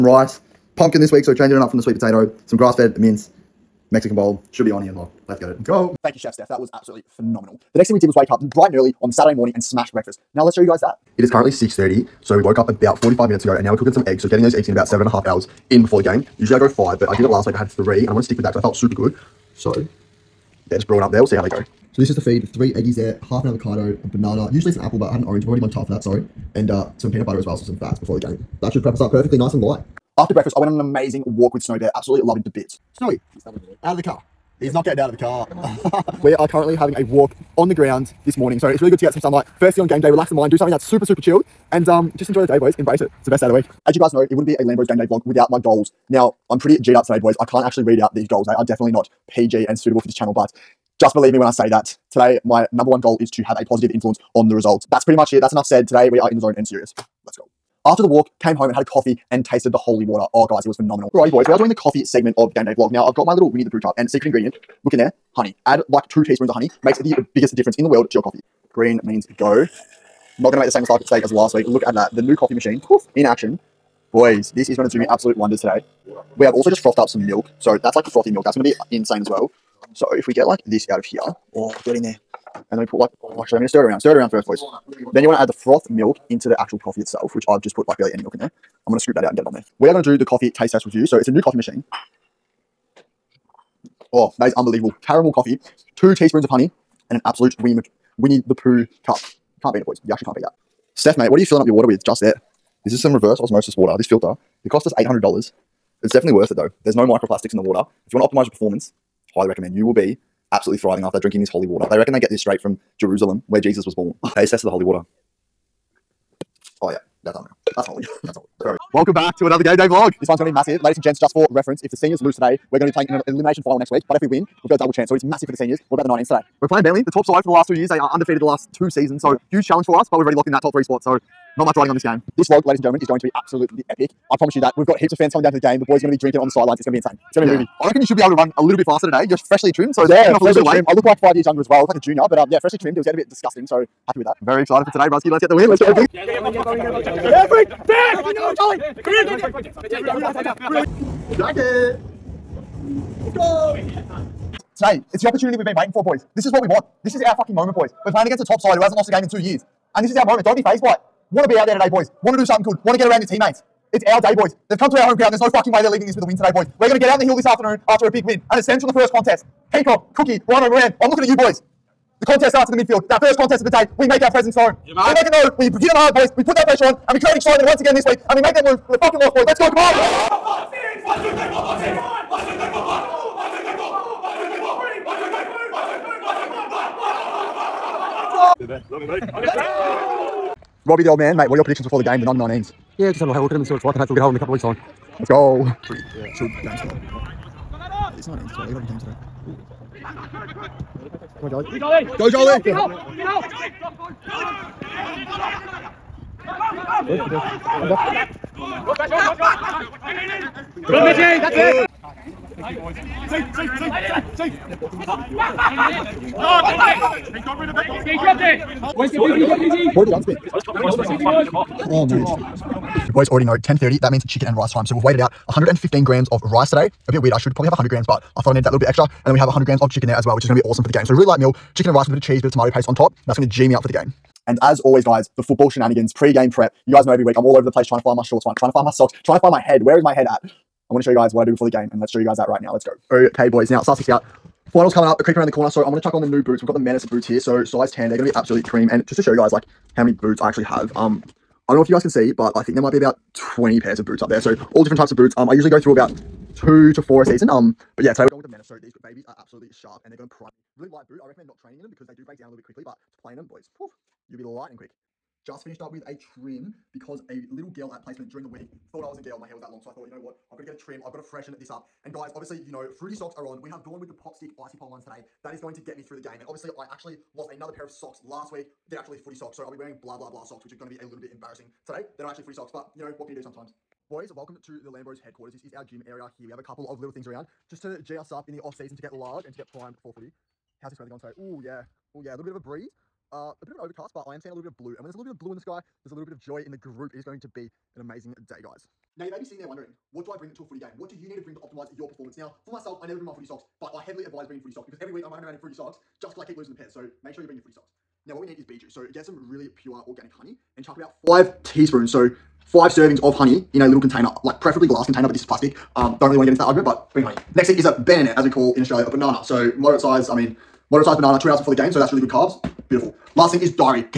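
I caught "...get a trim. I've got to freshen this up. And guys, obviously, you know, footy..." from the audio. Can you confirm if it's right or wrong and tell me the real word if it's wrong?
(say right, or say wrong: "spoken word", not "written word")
wrong: "fruity", not "footy".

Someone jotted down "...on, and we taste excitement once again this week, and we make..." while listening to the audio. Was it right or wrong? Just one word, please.
wrong.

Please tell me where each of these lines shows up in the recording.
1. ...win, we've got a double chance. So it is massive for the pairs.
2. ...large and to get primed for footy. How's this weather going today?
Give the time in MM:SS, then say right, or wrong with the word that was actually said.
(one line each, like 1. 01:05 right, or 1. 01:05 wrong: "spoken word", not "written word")
1. 02:04 wrong: "seniors", not "pairs"
2. 04:49 right.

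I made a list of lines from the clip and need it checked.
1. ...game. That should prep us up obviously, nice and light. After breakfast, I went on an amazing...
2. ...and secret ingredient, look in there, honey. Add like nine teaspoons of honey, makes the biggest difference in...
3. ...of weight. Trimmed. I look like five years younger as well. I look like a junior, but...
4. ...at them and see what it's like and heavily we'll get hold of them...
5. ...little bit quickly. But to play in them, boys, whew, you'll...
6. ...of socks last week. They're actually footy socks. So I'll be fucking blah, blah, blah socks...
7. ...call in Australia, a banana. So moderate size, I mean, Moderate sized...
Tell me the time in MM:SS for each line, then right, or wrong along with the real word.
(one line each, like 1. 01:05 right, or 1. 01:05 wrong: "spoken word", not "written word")
1. 00:28 wrong: "perfectly", not "obviously"
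2. 01:03 wrong: "two", not "nine"
3. 02:20 right
4. 03:13 wrong: "hopefully", not "heavily"
5. 04:22 right
6. 04:37 wrong: "wearing", not "fucking"
7. 05:18 right.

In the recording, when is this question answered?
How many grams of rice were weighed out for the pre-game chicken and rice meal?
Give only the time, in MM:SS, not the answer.
03:45.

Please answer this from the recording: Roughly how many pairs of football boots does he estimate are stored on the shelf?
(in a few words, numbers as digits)
20.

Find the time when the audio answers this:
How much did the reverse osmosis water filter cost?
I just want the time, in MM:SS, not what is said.
01:44.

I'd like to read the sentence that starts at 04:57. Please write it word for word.
It is going to be an amazing day, guys.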